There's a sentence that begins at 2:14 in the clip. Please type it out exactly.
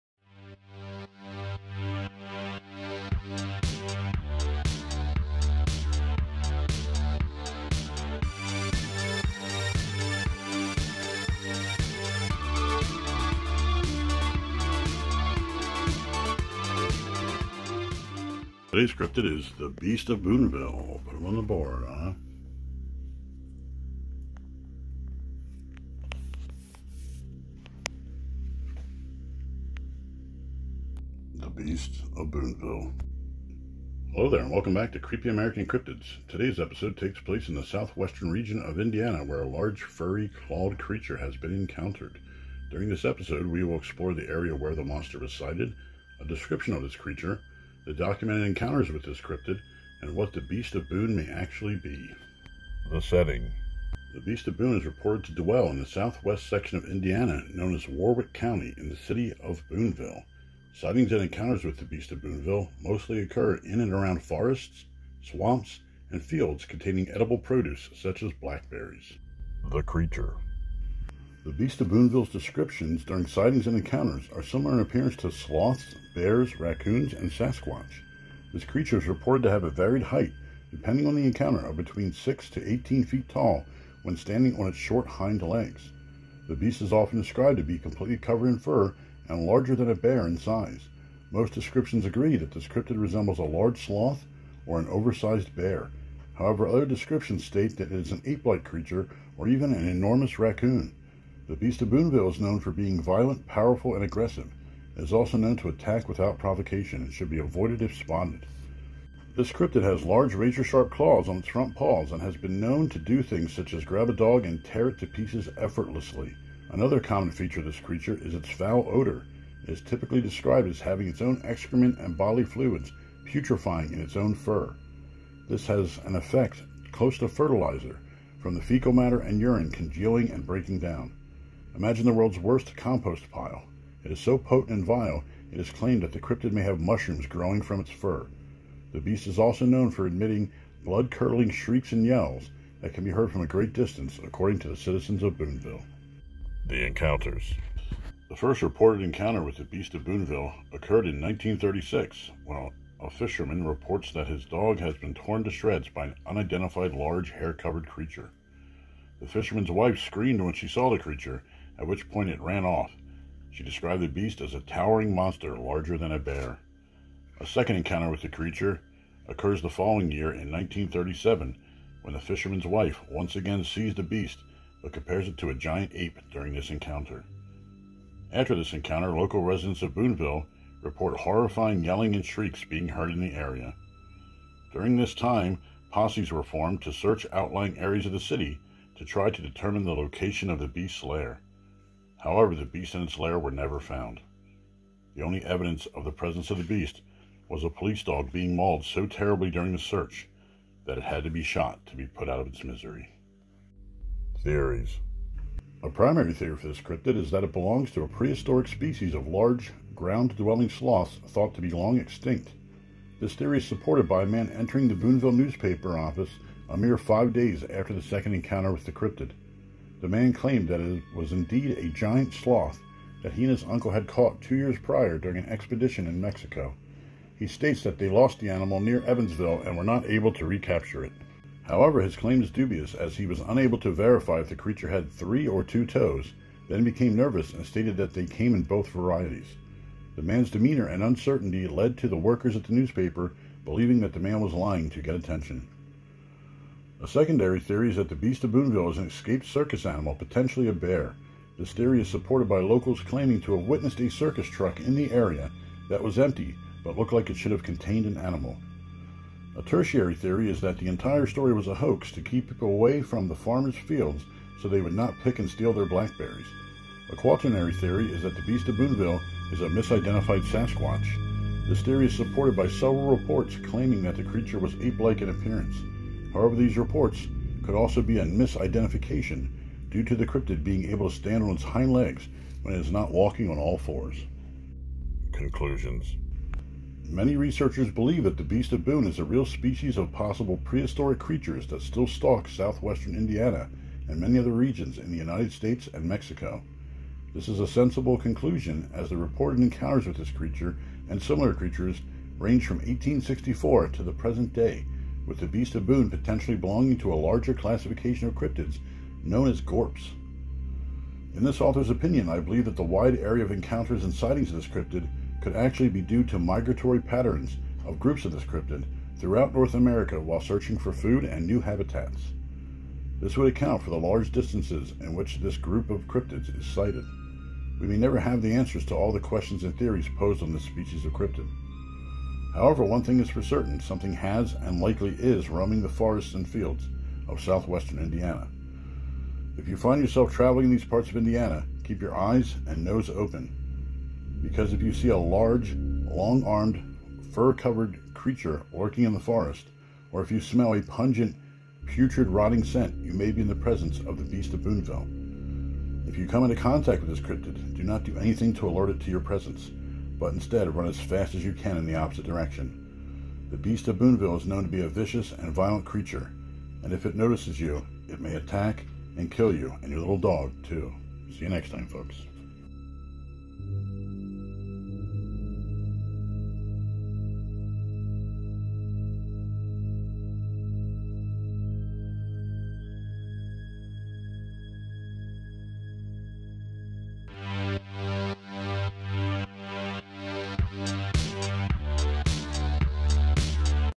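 It is so potent and vile, it is claimed that the cryptid may have mushrooms growing from its fur.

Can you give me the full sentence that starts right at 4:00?
The man's demeanor and uncertainty led to the workers at the newspaper believing that the man was lying to get attention.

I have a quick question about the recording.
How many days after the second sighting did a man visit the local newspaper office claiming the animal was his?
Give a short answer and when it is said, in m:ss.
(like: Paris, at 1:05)
5, at 3:36.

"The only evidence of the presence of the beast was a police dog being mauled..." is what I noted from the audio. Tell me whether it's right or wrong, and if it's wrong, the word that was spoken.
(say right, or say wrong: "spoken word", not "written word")
right.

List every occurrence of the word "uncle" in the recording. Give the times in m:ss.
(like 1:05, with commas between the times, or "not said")
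3:43.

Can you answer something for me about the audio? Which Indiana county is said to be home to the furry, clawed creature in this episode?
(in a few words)
Warrick County.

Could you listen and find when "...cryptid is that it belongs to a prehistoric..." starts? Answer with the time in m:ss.
3:26.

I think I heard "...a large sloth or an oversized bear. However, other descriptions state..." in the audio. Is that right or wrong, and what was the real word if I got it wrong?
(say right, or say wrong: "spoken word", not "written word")
right.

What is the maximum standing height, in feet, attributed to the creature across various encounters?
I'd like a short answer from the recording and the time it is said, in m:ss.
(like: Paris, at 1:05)
18, at 1:22.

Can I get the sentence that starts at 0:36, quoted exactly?
Today's episode takes place in the southwestern region of Indiana, where a large furry clawed creature has been encountered.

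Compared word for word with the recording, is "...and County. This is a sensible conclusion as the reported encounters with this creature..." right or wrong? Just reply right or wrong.
wrong.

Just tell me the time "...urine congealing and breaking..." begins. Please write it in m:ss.
2:09.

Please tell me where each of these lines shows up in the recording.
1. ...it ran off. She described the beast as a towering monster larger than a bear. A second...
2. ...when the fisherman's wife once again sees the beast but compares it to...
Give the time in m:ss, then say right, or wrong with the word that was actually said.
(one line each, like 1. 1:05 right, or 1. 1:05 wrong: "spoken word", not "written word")
1. 2:42 right
2. 2:52 right.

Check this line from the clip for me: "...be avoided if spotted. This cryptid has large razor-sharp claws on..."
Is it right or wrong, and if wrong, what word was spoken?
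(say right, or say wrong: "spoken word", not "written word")
right.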